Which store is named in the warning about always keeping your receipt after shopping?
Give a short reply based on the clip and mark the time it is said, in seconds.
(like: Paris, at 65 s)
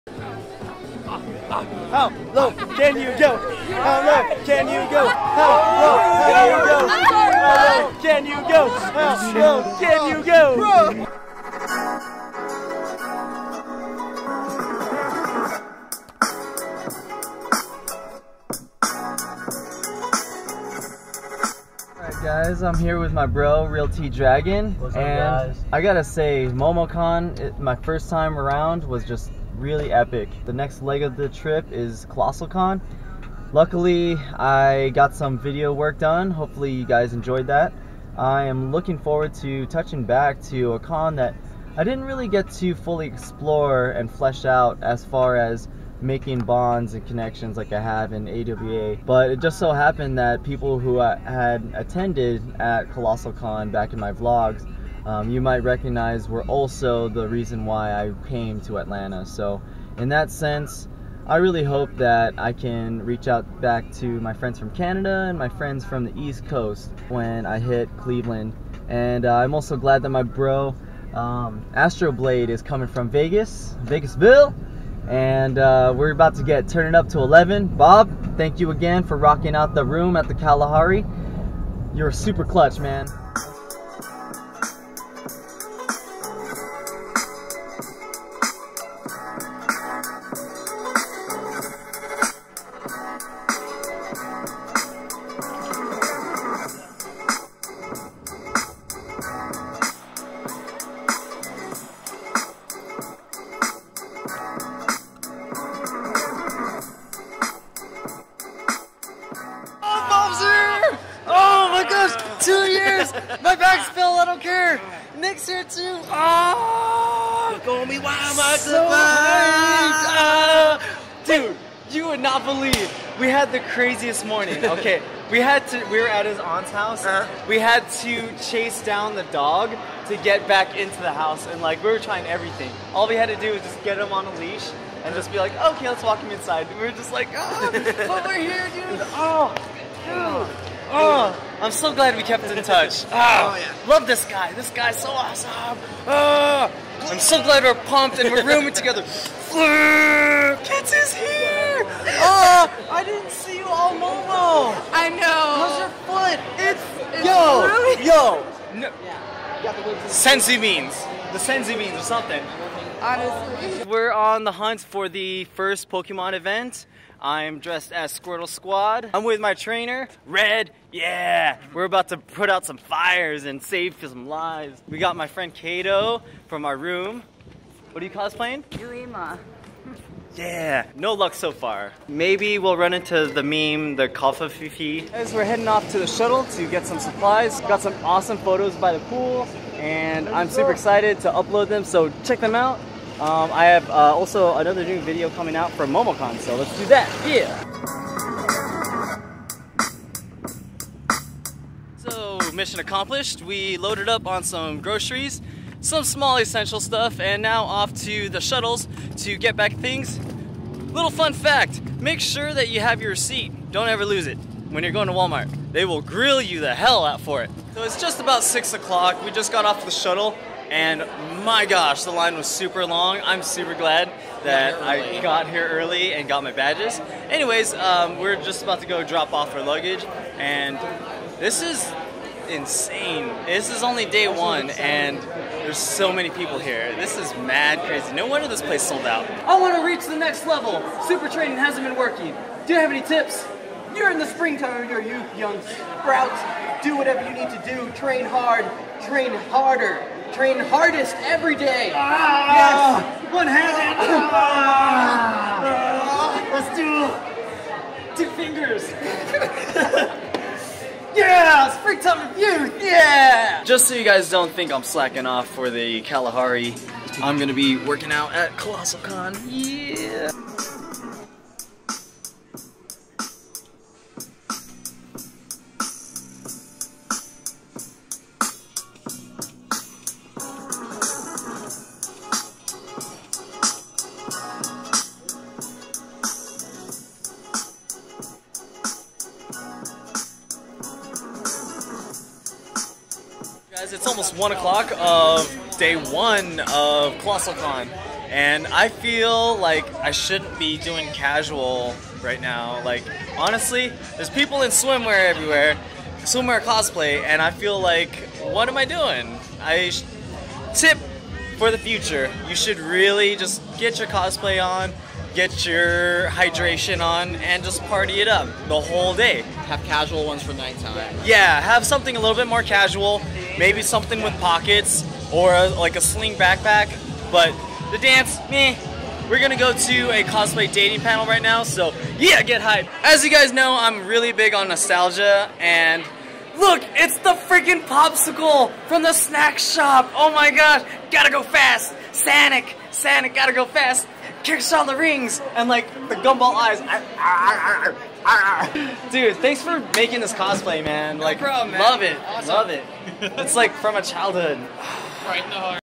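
Walmart, at 215 s.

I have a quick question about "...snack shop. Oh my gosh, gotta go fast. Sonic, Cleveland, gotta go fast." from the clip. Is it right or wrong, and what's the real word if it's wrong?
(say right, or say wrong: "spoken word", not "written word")
wrong: "Sonic", not "Cleveland".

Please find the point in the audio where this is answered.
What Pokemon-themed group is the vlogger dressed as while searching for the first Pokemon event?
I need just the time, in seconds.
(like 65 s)
168 s.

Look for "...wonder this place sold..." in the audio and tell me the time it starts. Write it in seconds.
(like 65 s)
238 s.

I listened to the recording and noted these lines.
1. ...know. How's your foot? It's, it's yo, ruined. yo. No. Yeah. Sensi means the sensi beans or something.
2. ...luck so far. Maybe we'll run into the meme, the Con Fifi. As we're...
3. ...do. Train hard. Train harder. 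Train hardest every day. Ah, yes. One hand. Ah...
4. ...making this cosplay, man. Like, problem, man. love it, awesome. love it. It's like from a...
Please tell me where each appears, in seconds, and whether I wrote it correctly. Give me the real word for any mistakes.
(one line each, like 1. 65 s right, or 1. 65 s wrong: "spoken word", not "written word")
1. 155 s right
2. 181 s wrong: "Kalfa", not "Con"
3. 247 s right
4. 349 s right.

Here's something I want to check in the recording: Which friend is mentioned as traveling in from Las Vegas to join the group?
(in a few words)
Astroblade.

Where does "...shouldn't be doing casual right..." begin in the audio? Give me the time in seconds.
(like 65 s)
300 s.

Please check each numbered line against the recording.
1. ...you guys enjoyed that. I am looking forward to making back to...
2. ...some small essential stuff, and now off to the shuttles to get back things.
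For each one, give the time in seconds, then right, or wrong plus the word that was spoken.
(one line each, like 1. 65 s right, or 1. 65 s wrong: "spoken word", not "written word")
1. 36 s wrong: "touching", not "making"
2. 205 s right.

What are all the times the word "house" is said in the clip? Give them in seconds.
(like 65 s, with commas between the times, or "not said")
126 s, 131 s.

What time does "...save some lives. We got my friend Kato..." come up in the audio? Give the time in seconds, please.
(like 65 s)
173 s.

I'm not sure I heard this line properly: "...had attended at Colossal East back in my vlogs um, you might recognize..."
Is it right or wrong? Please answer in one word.
wrong.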